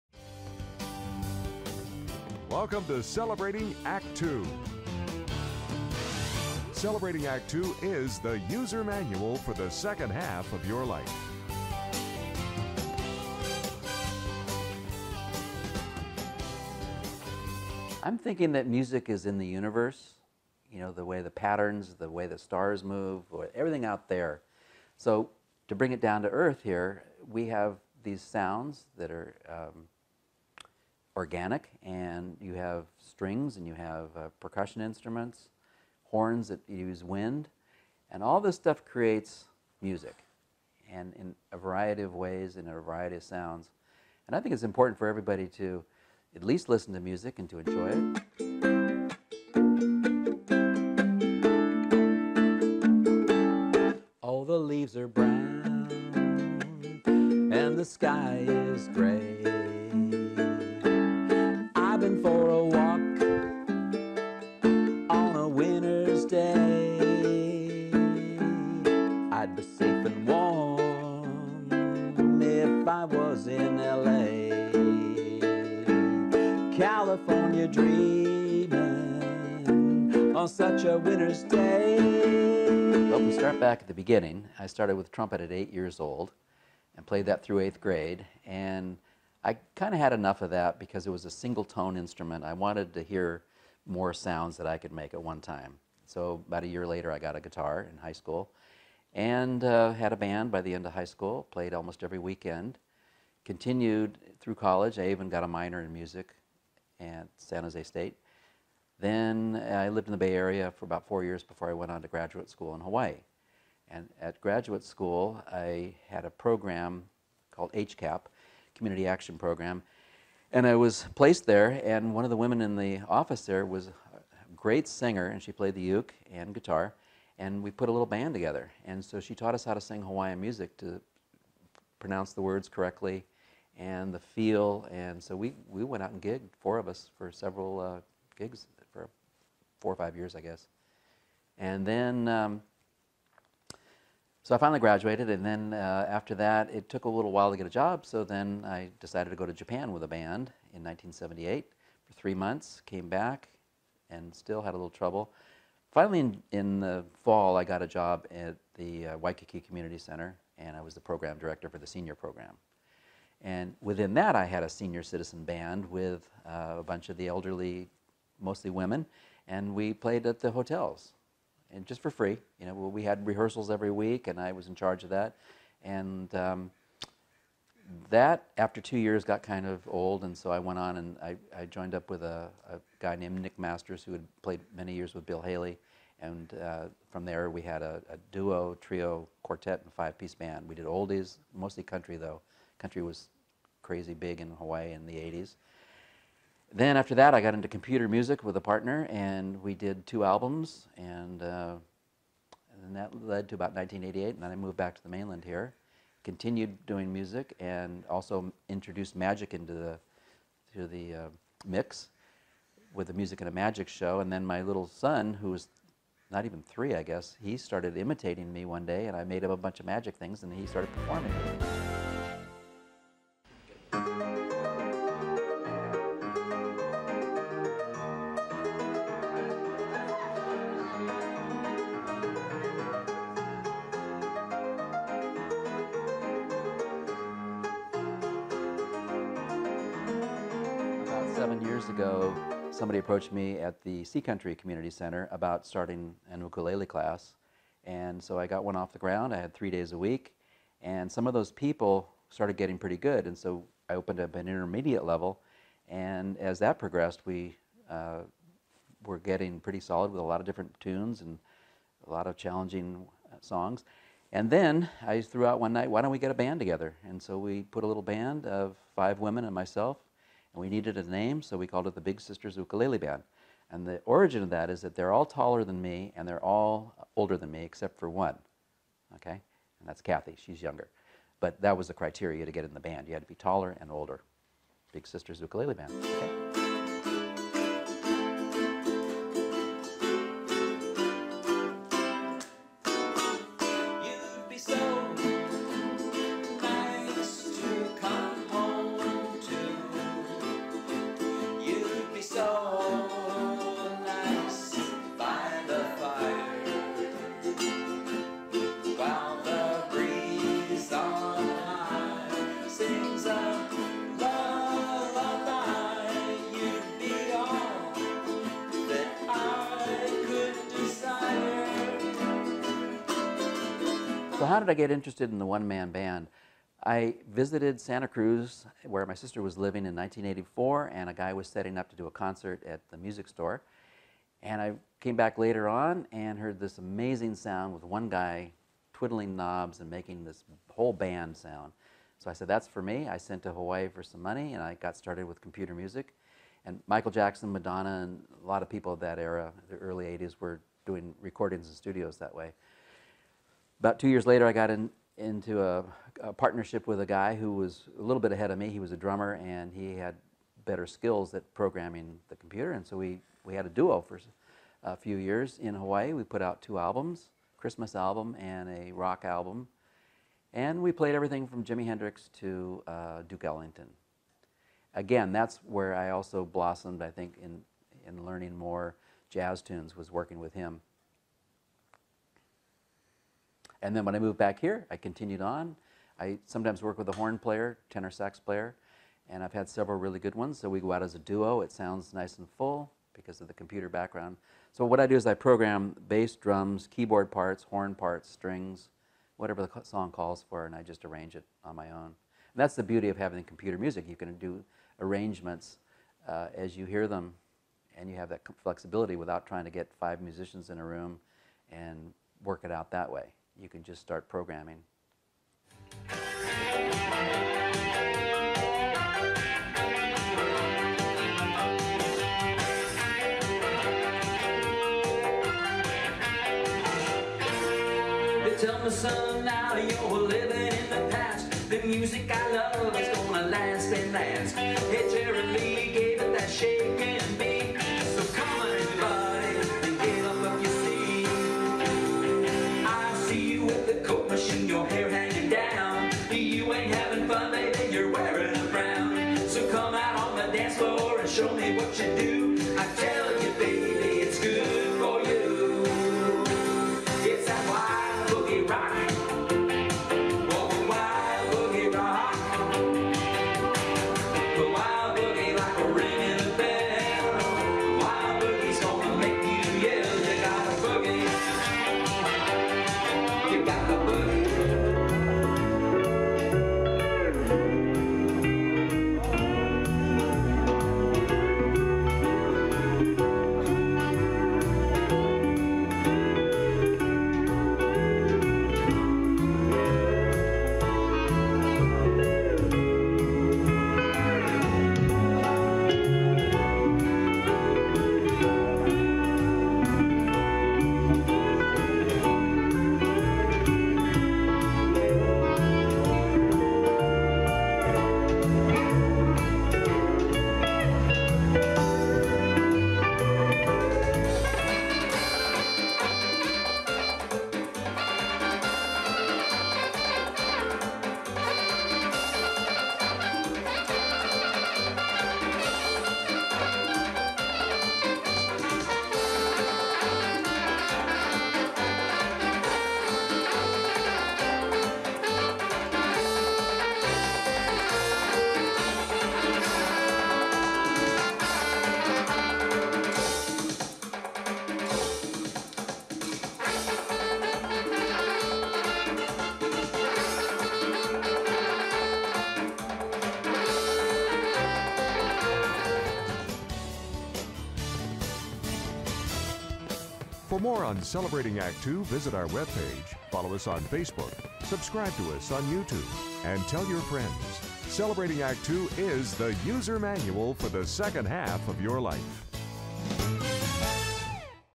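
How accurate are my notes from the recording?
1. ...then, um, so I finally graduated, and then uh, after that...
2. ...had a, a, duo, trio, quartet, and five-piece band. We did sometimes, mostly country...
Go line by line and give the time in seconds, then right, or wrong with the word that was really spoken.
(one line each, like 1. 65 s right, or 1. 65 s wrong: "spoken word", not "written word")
1. 141 s right
2. 187 s wrong: "oldies", not "sometimes".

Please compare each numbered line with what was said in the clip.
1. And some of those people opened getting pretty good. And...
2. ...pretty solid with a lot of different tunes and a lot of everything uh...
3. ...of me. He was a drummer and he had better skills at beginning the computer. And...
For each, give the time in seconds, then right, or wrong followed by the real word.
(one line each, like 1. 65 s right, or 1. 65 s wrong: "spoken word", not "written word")
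1. 250 s wrong: "started", not "opened"
2. 259 s wrong: "challenging", not "everything"
3. 358 s wrong: "programming", not "beginning".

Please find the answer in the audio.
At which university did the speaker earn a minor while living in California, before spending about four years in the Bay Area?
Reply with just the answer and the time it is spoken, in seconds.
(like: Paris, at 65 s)
San Jose State, at 107 s.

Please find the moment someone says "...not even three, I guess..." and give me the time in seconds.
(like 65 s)
216 s.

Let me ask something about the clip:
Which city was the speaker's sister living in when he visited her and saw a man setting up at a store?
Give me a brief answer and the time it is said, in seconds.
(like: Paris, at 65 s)
Santa Cruz, at 327 s.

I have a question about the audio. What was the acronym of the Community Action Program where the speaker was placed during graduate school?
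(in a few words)
HCAP.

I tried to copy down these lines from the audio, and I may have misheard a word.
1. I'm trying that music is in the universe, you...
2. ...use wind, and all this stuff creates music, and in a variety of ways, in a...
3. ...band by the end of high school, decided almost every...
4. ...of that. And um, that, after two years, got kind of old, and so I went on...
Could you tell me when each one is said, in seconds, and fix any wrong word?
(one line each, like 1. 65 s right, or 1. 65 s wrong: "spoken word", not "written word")
1. 18 s wrong: "thinking", not "trying"
2. 36 s right
3. 100 s wrong: "played", not "decided"
4. 175 s right.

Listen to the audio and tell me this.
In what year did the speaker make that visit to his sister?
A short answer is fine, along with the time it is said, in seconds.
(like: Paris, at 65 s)
1984, at 329 s.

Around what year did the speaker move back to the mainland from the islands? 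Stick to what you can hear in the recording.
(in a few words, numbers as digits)
1988.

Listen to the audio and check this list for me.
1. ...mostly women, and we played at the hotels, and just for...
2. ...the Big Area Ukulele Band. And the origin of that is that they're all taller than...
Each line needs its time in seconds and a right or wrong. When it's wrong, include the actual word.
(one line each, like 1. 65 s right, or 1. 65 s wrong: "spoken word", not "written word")
1. 168 s right
2. 271 s wrong: "Sisters", not "Area".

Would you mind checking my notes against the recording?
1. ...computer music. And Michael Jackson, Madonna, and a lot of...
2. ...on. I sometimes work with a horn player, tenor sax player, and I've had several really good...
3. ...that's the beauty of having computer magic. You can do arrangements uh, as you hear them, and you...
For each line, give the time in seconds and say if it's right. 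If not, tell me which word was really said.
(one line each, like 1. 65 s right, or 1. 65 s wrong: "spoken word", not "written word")
1. 345 s right
2. 385 s right
3. 402 s wrong: "music", not "magic".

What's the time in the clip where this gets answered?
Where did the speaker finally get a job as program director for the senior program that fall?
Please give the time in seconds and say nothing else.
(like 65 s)
159 s.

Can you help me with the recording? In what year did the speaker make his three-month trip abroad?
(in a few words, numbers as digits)
1978.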